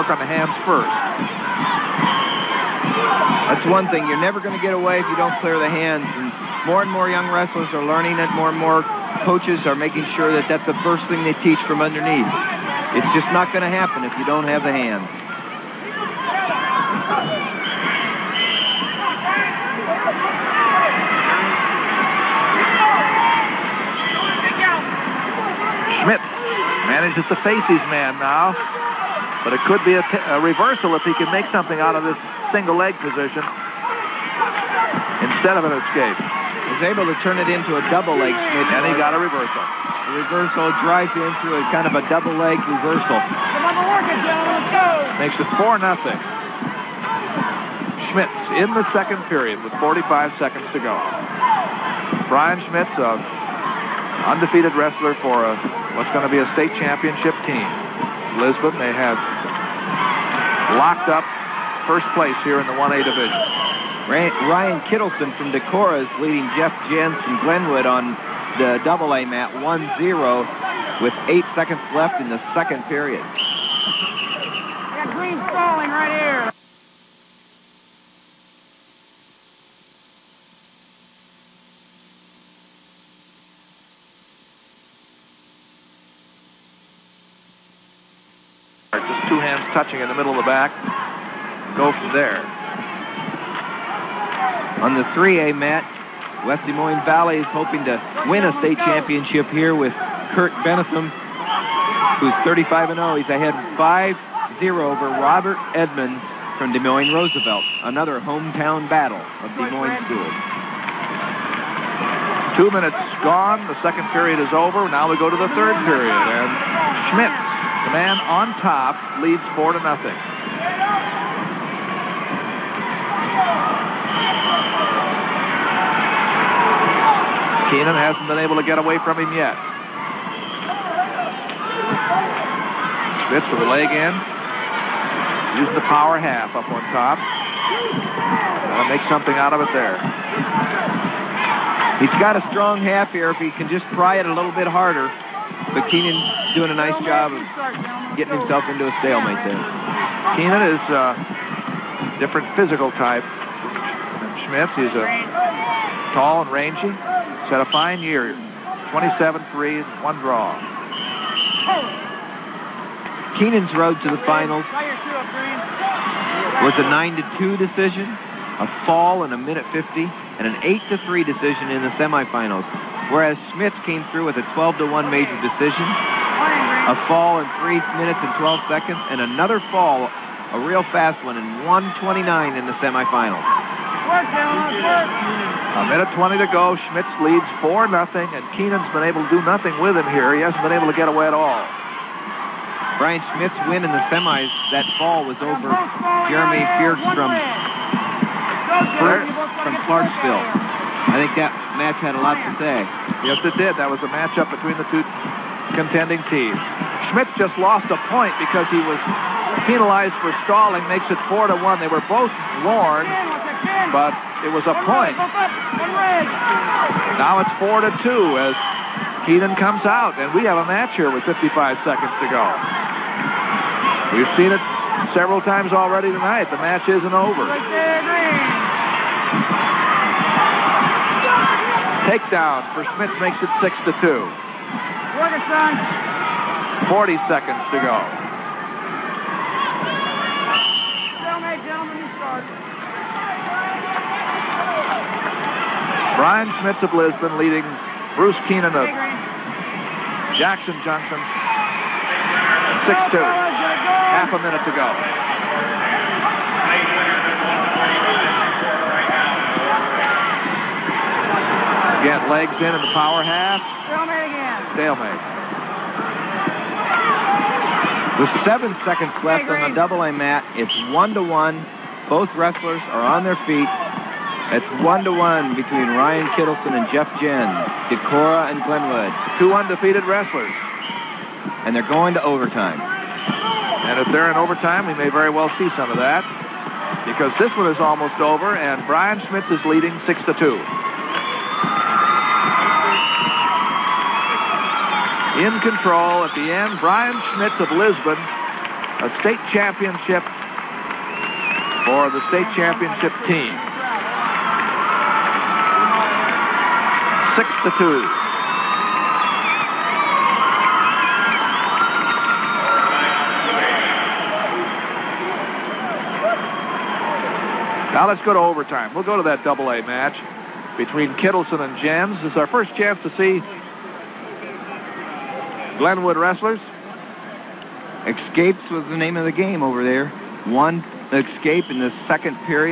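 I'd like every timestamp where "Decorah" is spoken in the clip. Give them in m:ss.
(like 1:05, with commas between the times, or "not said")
1:05, 4:37.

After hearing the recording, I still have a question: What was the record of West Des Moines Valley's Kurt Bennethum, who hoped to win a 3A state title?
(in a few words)
35-0.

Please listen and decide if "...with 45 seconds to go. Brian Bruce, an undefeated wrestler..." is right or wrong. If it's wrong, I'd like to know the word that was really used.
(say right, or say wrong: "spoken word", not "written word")
wrong: "Schmitz", not "Bruce".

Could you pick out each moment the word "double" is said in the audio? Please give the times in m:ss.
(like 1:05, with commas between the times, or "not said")
0:37, 0:42, 1:08, 4:29, 5:19.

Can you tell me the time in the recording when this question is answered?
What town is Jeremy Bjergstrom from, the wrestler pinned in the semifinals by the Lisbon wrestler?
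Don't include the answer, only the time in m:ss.
3:19.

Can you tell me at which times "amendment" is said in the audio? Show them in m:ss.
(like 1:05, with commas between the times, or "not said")
not said.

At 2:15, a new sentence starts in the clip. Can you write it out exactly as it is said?
Using the power half up on top.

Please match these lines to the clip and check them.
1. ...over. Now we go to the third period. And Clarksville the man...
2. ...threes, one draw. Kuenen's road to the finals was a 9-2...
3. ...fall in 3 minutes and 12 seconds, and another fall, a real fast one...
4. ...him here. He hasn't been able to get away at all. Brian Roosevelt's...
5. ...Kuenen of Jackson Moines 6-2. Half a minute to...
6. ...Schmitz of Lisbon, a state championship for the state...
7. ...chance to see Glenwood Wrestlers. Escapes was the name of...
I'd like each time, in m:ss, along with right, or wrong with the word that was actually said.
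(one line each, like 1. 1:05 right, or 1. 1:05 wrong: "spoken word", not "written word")
1. 1:54 wrong: "Schmitz", not "Clarksville"
2. 2:39 right
3. 2:57 right
4. 3:09 wrong: "Schmitz", not "Roosevelt"
5. 4:08 wrong: "Junction", not "Moines"
6. 4:57 right
7. 5:22 right.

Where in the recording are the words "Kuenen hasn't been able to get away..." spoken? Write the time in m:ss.
2:07.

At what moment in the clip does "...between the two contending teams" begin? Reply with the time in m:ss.
3:24.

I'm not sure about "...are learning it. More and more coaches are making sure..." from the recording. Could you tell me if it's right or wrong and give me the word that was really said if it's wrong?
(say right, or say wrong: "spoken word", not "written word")
right.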